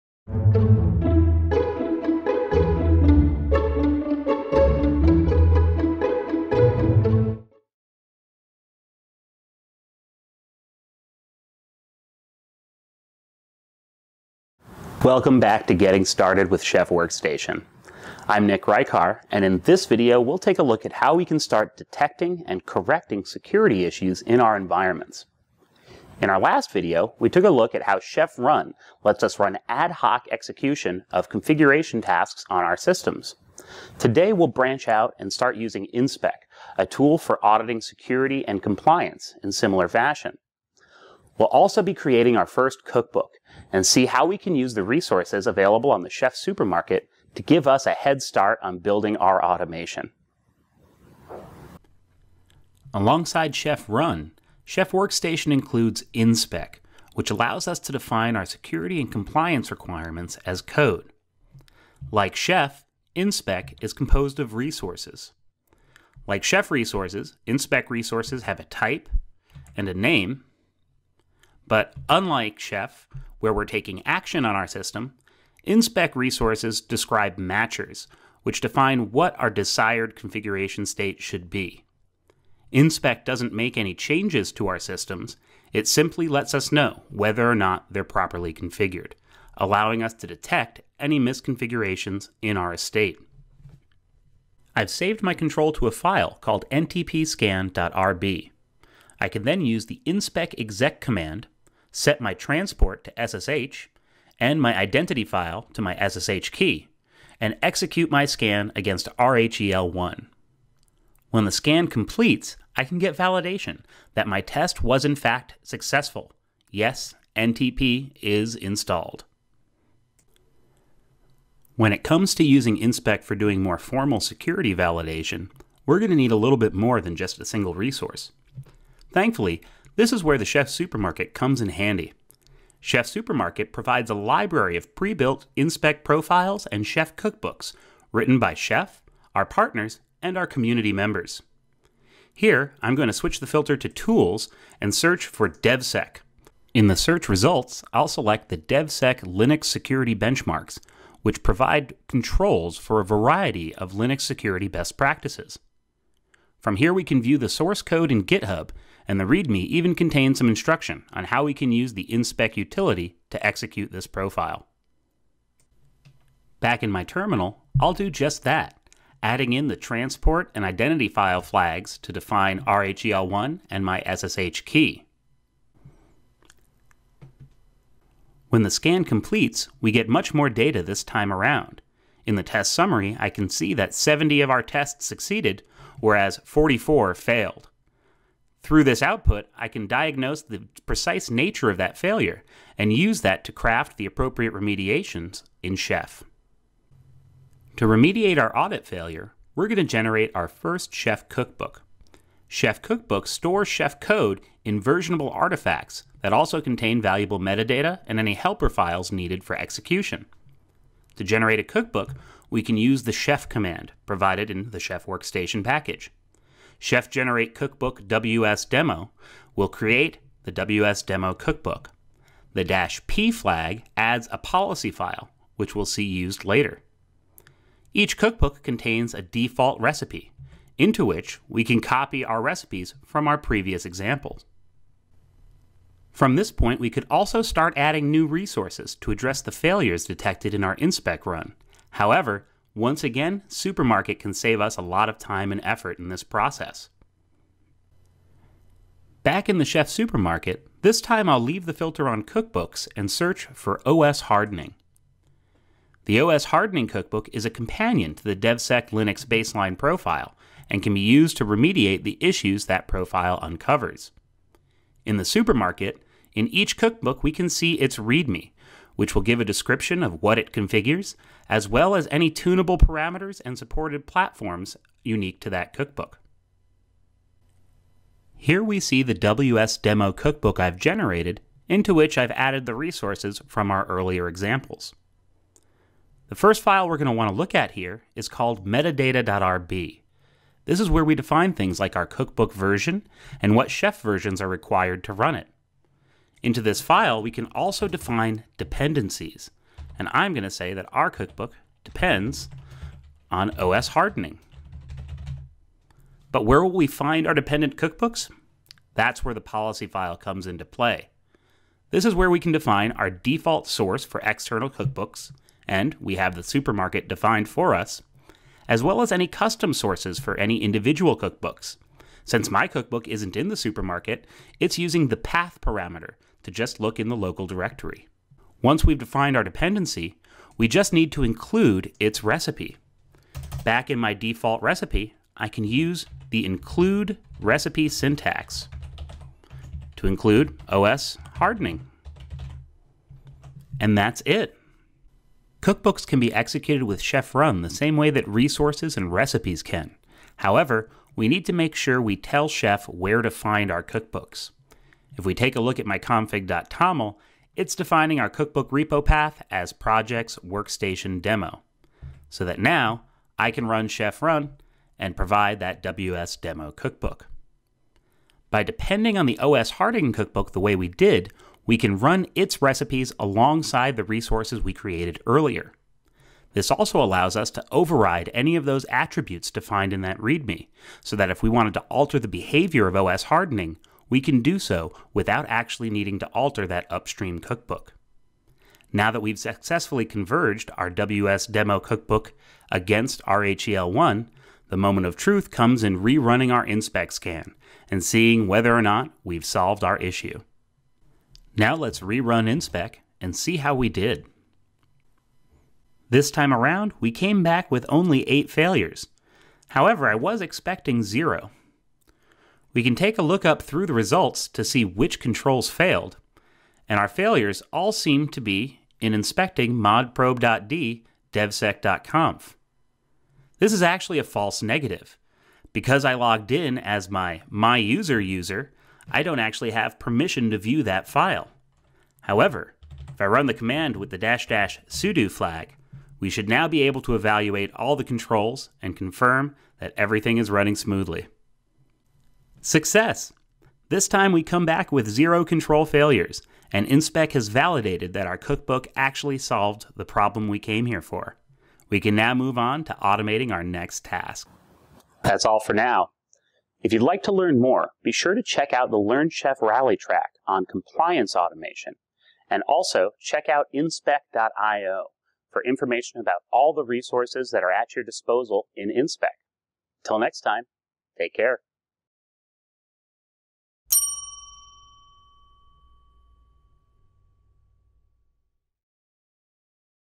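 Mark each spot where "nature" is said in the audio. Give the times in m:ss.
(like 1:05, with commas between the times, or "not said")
3:11.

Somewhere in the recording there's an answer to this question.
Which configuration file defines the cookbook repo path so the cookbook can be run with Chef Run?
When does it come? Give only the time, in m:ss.
5:55.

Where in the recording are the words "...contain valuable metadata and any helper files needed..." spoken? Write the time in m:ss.
3:26.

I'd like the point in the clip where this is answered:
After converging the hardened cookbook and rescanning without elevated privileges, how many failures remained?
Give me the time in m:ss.
6:48.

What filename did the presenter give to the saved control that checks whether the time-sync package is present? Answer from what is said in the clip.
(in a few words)
ntpscan.rb.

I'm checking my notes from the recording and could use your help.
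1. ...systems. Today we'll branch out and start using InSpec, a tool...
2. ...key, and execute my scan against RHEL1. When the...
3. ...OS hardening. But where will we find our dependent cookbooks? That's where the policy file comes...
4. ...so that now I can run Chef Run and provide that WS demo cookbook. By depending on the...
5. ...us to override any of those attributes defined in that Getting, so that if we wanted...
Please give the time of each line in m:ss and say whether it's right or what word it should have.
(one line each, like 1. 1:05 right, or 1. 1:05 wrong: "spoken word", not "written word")
1. 0:32 right
2. 1:46 right
3. 5:03 right
4. 6:02 right
5. 6:17 wrong: "README", not "Getting".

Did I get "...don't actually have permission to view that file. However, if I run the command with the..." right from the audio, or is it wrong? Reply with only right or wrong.
right.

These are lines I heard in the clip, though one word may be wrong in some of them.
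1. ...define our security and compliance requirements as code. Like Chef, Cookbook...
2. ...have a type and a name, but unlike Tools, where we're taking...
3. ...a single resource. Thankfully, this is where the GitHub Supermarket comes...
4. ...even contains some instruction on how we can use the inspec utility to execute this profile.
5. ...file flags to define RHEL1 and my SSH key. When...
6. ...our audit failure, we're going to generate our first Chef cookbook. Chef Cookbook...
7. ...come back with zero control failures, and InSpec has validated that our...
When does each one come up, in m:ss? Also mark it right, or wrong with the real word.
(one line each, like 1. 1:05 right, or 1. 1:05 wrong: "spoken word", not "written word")
1. 0:57 wrong: "InSpec", not "Cookbook"
2. 1:08 wrong: "Chef", not "Tools"
3. 2:07 wrong: "Chef", not "GitHub"
4. 2:39 right
5. 2:51 right
6. 3:18 right
7. 7:24 right.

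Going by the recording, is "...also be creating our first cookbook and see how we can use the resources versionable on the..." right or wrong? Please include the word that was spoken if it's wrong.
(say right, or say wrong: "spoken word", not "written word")
wrong: "available", not "versionable".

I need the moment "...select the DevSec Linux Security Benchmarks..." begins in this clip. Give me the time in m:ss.
2:28.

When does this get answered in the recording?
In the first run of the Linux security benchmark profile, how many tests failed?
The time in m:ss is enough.
3:06.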